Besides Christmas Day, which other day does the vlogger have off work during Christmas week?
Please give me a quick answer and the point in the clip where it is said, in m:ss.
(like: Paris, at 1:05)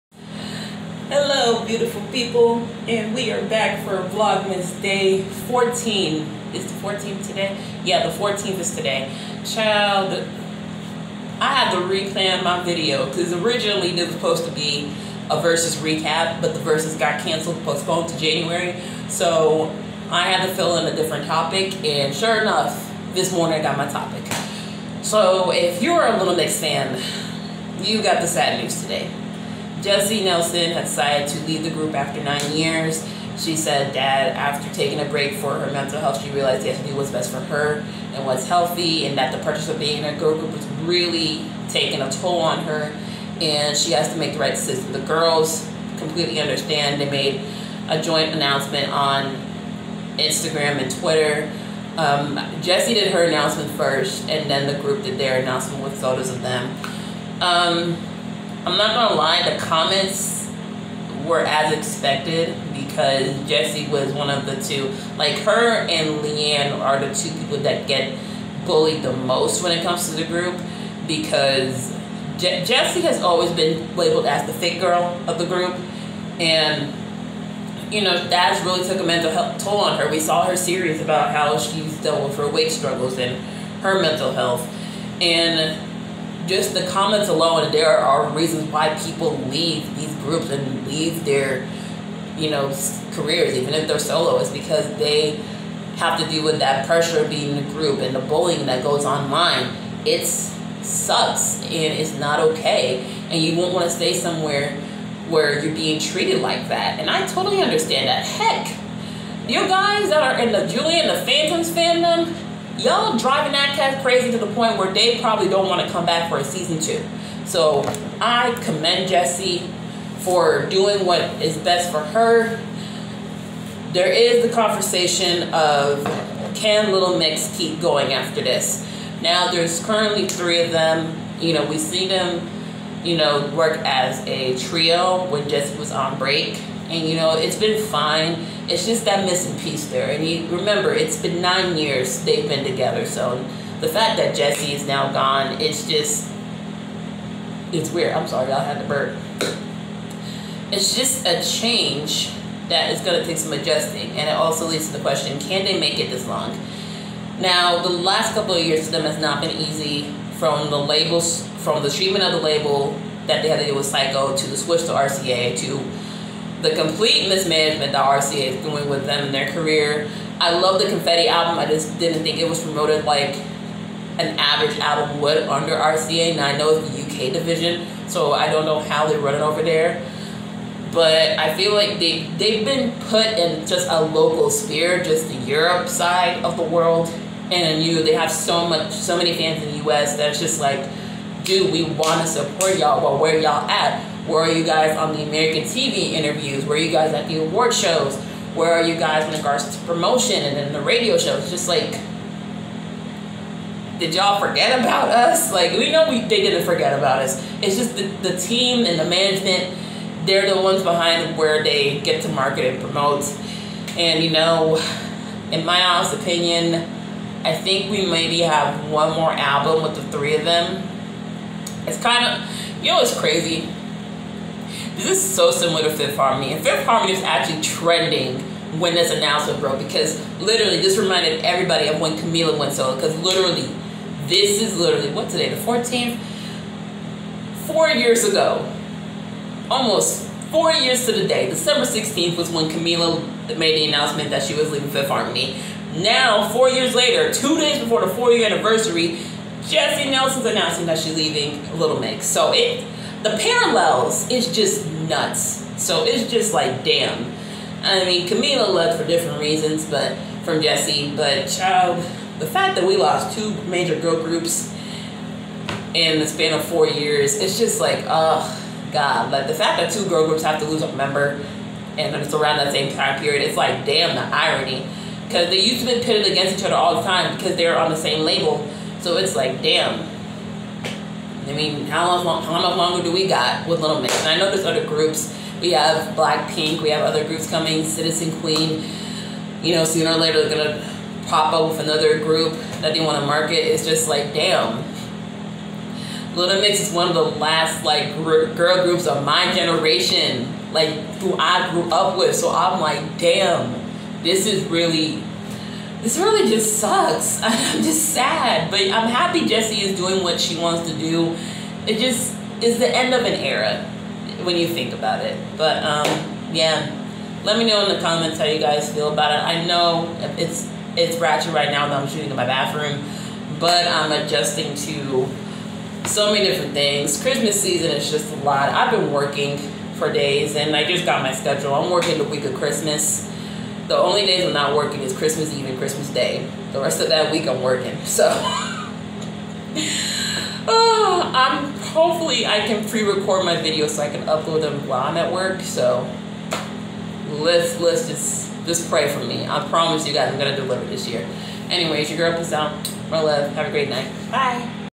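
Christmas Eve, at 5:35.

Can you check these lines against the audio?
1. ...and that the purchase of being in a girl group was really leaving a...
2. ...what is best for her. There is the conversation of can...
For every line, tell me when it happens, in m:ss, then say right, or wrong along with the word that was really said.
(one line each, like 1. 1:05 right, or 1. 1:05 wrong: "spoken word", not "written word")
1. 0:39 wrong: "taking", not "leaving"
2. 2:01 right.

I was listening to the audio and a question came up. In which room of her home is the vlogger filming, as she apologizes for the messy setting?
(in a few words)
Bathroom.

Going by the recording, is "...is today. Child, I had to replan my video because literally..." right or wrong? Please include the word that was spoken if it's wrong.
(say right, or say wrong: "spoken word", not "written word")
wrong: "originally", not "literally".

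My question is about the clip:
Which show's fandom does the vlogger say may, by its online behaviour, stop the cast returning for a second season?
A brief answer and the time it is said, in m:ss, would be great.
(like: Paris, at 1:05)
Julie and the Phantoms, at 1:50.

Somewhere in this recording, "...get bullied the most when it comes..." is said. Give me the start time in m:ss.
1:07.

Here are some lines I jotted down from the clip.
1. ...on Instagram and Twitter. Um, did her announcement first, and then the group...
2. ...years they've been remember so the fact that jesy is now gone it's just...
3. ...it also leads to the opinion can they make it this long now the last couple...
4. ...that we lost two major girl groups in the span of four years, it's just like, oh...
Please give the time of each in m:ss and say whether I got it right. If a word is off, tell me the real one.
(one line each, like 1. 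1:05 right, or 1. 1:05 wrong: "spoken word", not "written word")
1. 0:48 right
2. 2:21 wrong: "together", not "remember"
3. 2:34 wrong: "question", not "opinion"
4. 4:22 right.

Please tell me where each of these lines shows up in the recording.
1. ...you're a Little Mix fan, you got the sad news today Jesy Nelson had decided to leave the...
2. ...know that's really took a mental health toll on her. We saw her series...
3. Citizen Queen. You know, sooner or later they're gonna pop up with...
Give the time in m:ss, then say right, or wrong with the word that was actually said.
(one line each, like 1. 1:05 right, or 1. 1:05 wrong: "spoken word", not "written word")
1. 0:25 right
2. 1:18 right
3. 4:47 right.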